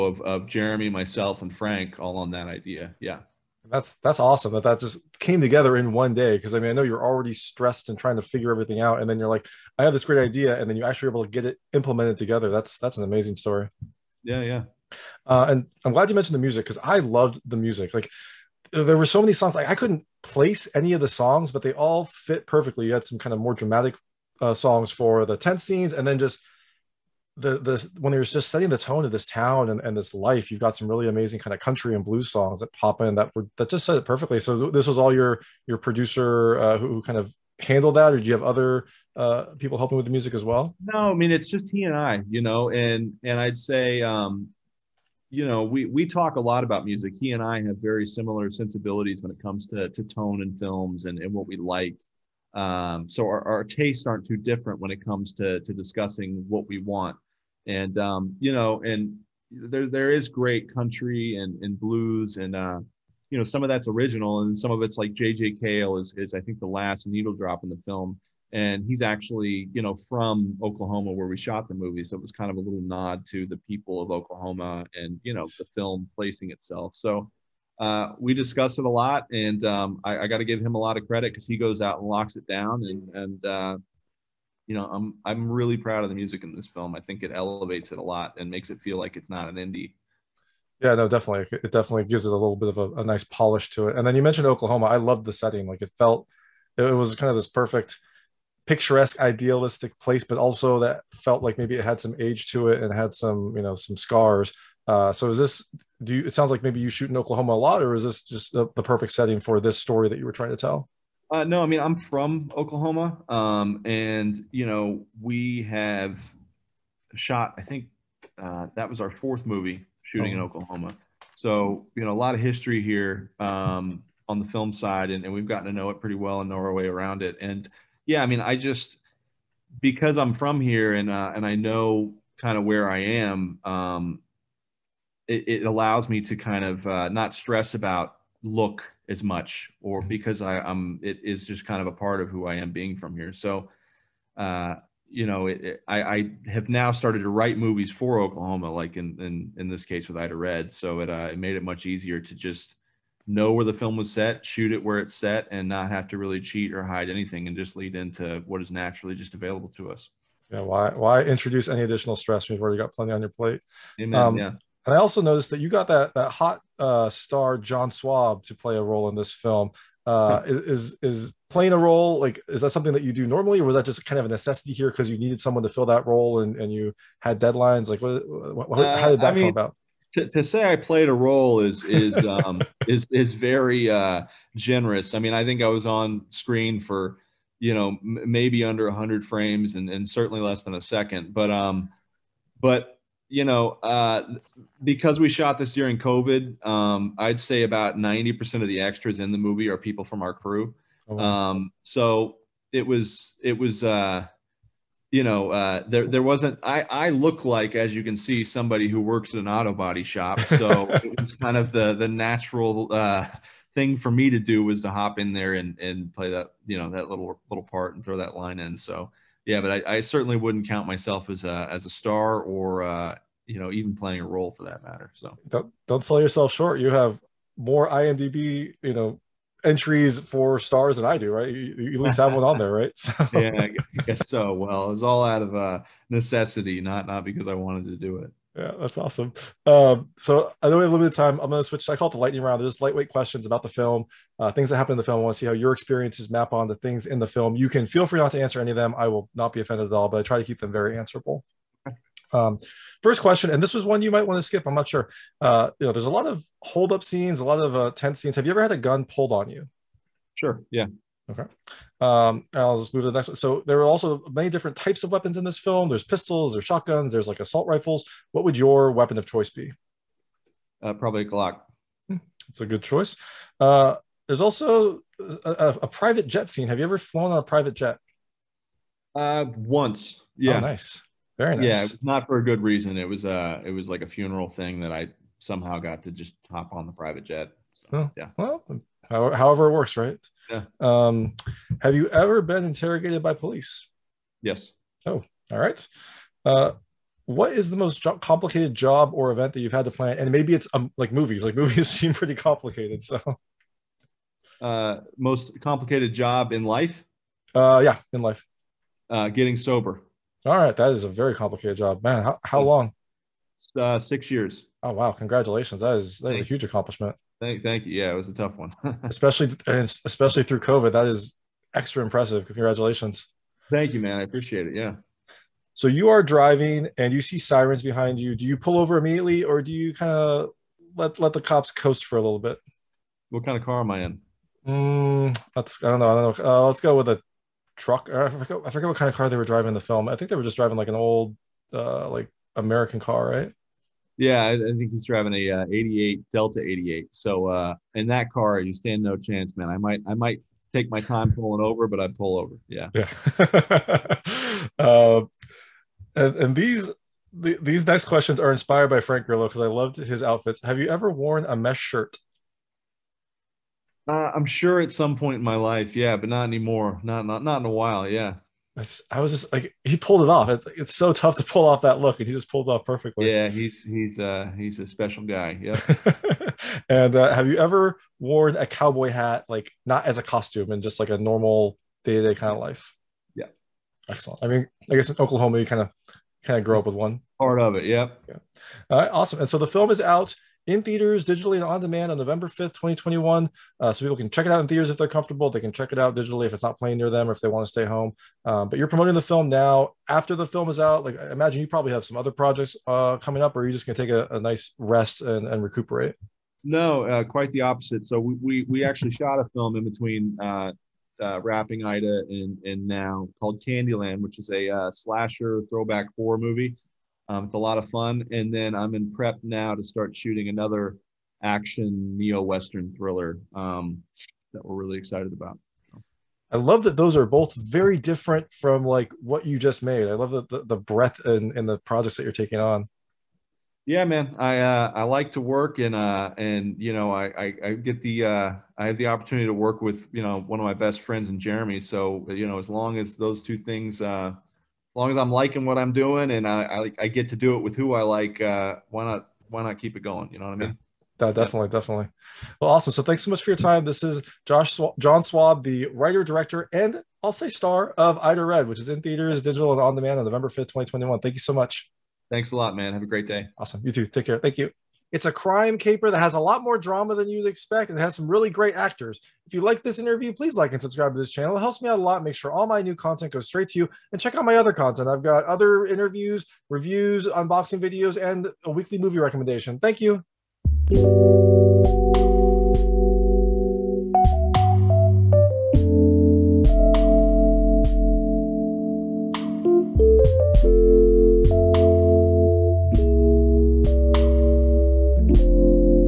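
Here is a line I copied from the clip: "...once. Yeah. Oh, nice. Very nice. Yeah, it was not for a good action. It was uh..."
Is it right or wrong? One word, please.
wrong.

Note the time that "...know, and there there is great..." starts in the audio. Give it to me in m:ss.
0:58.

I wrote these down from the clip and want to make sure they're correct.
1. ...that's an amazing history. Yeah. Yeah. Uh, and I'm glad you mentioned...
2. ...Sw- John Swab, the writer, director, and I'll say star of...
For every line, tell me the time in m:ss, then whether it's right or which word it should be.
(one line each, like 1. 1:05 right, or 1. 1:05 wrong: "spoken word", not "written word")
1. 0:12 wrong: "story", not "history"
2. 7:34 right.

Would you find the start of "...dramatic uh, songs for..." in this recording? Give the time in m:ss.
0:23.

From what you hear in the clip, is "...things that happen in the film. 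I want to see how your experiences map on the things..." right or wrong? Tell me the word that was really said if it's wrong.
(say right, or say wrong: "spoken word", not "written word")
right.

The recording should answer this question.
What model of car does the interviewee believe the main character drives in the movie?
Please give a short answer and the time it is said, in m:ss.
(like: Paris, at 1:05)
Delta 88, at 5:46.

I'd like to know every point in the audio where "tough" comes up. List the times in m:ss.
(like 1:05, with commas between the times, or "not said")
5:18, 6:11.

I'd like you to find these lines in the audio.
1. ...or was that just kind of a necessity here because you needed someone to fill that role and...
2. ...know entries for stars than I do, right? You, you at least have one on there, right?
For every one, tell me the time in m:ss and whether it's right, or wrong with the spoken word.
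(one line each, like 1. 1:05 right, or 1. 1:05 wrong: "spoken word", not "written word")
1. 2:53 right
2. 3:48 right.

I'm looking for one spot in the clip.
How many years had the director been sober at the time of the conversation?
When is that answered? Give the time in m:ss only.
5:13.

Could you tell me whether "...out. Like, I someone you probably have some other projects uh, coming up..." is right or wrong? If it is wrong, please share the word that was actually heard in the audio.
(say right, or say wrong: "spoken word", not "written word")
wrong: "imagine", not "someone".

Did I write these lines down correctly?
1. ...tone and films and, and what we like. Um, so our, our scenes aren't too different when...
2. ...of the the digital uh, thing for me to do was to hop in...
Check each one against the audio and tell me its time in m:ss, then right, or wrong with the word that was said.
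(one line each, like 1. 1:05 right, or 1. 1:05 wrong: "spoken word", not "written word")
1. 0:50 wrong: "tastes", not "scenes"
2. 3:31 wrong: "natural", not "digital".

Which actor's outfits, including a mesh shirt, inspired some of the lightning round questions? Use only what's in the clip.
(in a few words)
Frank Grillo.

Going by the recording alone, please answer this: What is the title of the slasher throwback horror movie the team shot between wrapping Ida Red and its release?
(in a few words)
Candyland.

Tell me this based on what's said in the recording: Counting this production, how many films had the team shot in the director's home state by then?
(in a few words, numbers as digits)
4.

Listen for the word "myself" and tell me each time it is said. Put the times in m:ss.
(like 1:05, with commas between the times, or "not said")
0:00, 3:40.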